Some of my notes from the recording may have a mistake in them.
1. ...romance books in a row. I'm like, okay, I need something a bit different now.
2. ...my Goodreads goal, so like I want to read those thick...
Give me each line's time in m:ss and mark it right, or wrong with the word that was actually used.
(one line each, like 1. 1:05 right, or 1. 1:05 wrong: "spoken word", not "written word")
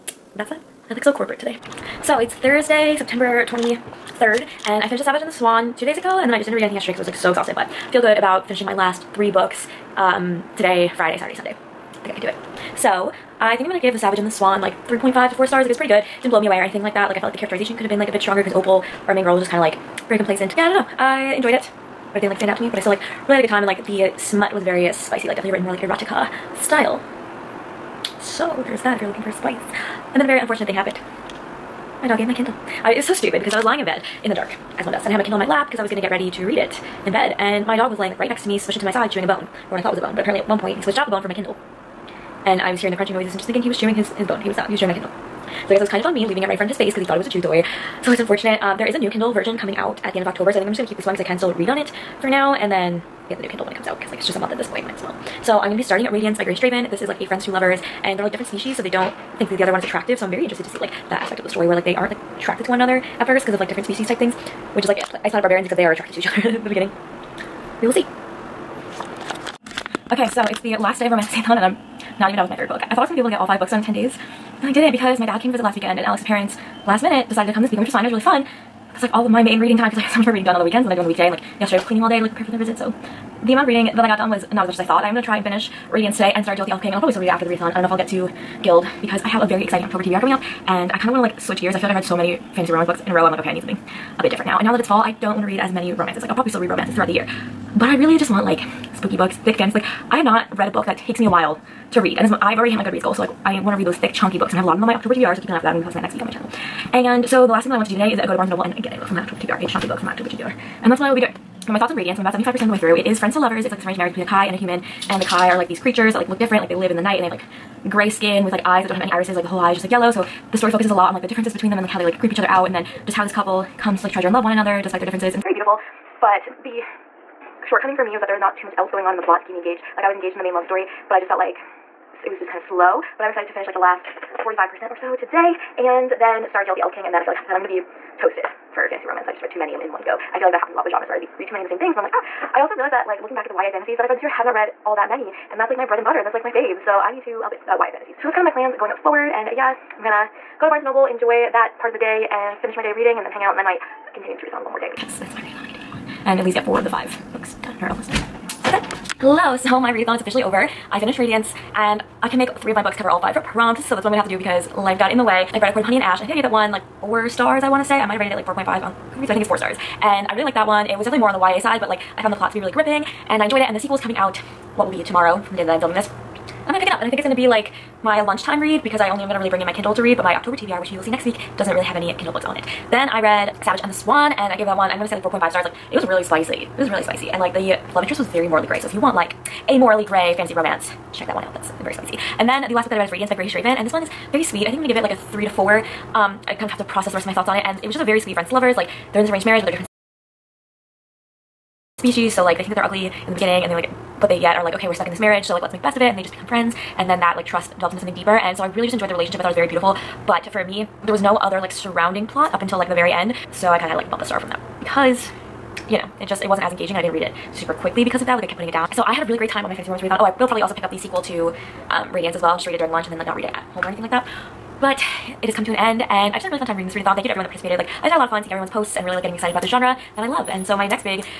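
1. 1:32 right
2. 1:42 right.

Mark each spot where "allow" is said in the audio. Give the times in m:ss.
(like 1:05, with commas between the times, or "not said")
not said.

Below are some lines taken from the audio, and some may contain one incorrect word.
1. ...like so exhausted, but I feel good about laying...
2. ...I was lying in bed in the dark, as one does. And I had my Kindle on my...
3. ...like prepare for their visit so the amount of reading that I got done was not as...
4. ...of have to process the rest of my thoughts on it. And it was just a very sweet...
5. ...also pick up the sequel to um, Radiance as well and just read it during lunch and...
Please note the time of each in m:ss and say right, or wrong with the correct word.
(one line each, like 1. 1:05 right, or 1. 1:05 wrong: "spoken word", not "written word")
1. 0:07 wrong: "finishing", not "laying"
2. 0:33 right
3. 1:22 right
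4. 3:16 right
5. 3:40 right.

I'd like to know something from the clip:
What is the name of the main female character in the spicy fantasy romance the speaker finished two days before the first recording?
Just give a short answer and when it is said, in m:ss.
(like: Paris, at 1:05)
Opal, at 0:18.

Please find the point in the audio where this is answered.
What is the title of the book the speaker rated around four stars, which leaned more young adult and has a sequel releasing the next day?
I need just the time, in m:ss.
2:45.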